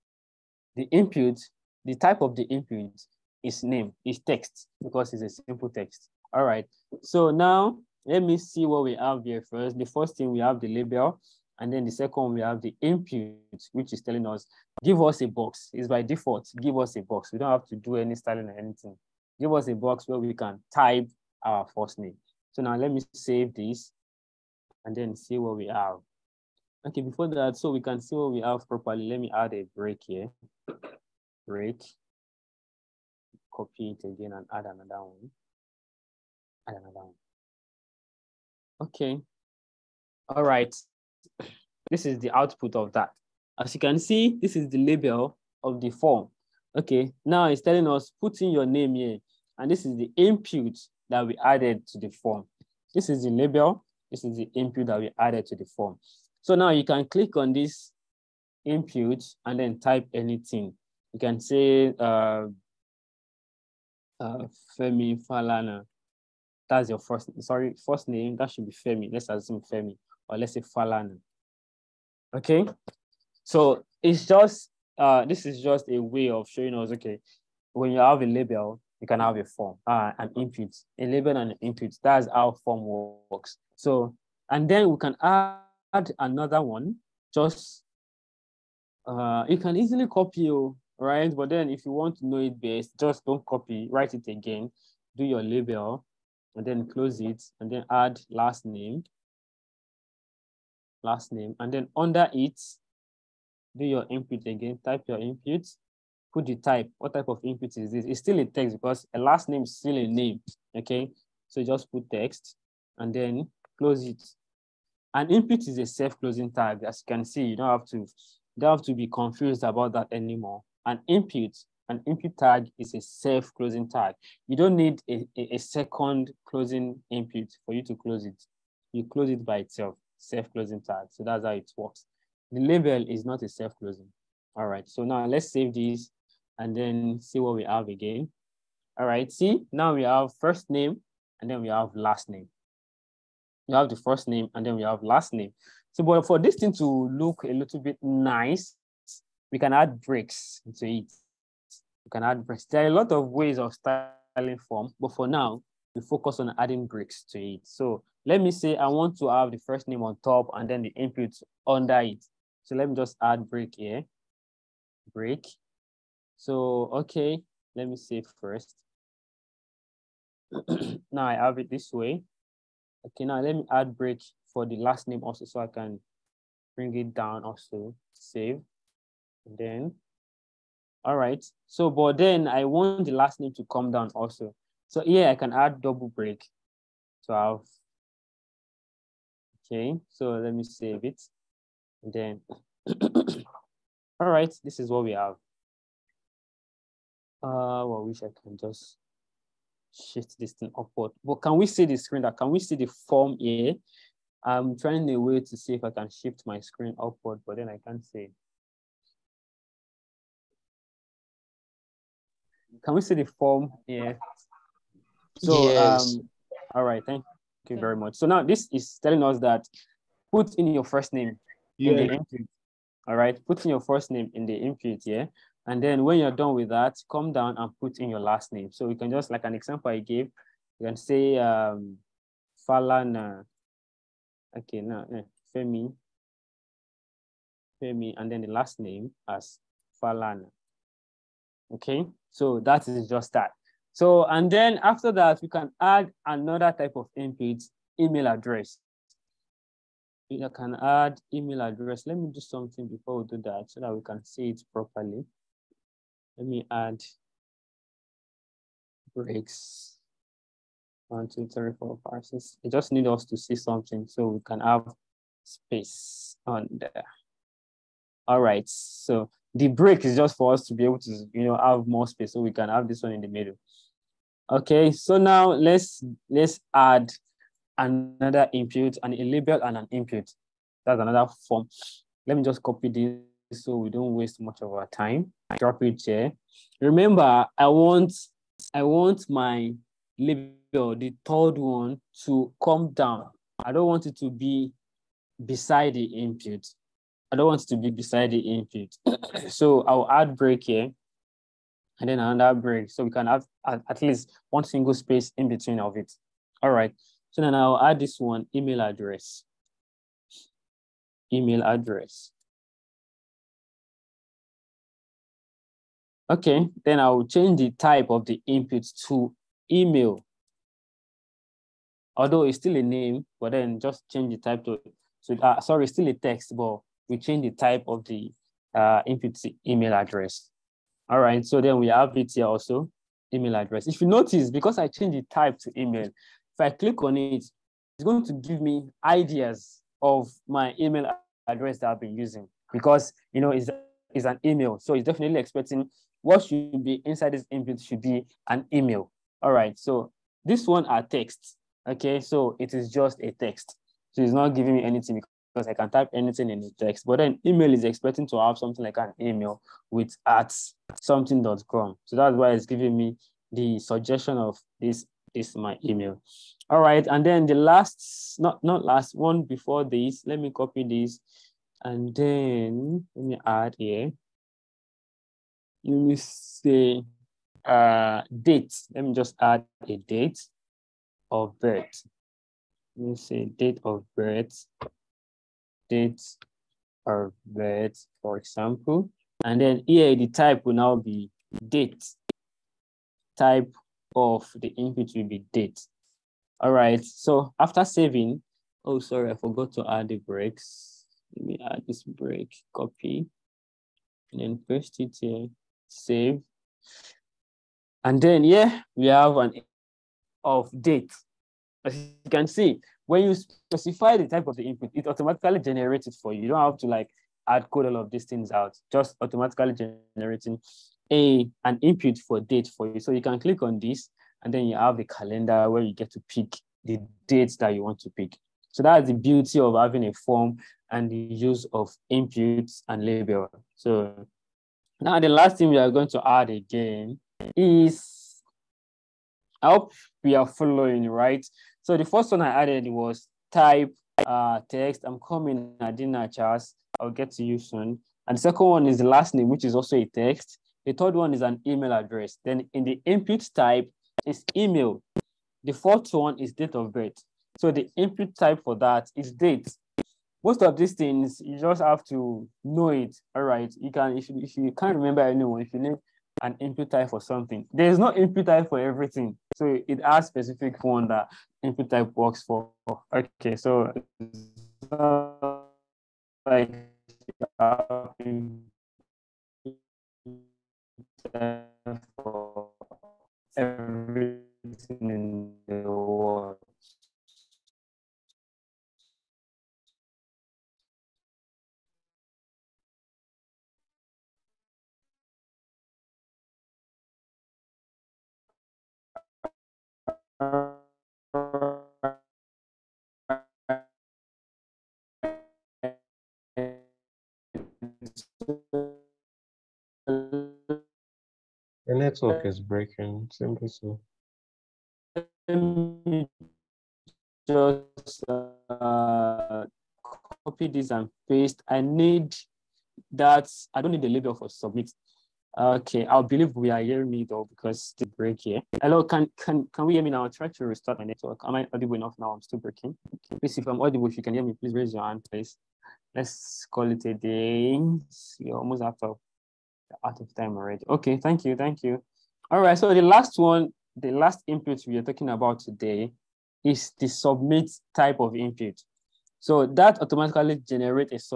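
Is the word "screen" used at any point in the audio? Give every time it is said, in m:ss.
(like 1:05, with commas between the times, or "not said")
3:21, 3:26.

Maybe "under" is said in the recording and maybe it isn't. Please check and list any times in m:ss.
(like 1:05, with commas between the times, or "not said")
1:41, 2:41.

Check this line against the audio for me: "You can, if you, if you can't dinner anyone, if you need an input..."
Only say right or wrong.
wrong.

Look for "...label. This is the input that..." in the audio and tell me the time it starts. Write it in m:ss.
0:53.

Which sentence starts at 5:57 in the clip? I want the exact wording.
But then email is expecting to have something like an email with at something.com.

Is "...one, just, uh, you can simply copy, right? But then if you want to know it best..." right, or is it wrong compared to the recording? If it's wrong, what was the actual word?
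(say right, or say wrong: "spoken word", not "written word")
wrong: "easily", not "simply".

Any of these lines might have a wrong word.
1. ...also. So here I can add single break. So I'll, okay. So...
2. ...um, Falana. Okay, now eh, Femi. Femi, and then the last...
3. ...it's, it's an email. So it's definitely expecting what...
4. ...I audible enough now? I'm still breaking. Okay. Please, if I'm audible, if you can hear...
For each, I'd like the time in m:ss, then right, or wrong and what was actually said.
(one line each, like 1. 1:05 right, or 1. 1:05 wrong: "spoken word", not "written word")
1. 3:04 wrong: "double", not "single"
2. 3:51 right
3. 5:43 right
4. 8:51 right.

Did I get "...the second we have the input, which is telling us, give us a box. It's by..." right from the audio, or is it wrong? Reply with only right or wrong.
right.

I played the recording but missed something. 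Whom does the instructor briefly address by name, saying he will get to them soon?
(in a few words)
Charles.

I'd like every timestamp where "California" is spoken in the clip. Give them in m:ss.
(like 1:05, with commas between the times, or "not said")
not said.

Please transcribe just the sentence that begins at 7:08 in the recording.
So that's the beauty of having a form and the use of inputs and label.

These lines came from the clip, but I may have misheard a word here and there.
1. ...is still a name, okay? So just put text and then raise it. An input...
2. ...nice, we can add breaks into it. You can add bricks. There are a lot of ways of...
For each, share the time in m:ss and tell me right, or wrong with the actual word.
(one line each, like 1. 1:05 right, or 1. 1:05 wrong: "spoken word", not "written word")
1. 1:49 wrong: "close", not "raise"
2. 2:28 right.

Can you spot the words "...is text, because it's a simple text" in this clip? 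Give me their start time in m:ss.
0:04.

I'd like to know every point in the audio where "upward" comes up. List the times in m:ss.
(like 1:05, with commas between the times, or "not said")
3:20, 3:26.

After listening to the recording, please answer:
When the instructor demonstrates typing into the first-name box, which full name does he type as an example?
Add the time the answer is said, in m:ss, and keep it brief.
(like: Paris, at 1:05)
Femi Falana, at 1:04.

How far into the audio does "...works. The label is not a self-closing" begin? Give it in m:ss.
2:11.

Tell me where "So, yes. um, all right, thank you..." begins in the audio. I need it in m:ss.
3:35.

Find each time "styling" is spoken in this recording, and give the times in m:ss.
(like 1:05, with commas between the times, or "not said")
0:18, 2:33.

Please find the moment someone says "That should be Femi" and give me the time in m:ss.
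1:08.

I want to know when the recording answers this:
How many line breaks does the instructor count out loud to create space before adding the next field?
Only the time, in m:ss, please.
4:22.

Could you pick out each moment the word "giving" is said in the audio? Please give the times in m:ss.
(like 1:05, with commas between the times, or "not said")
5:54, 6:02.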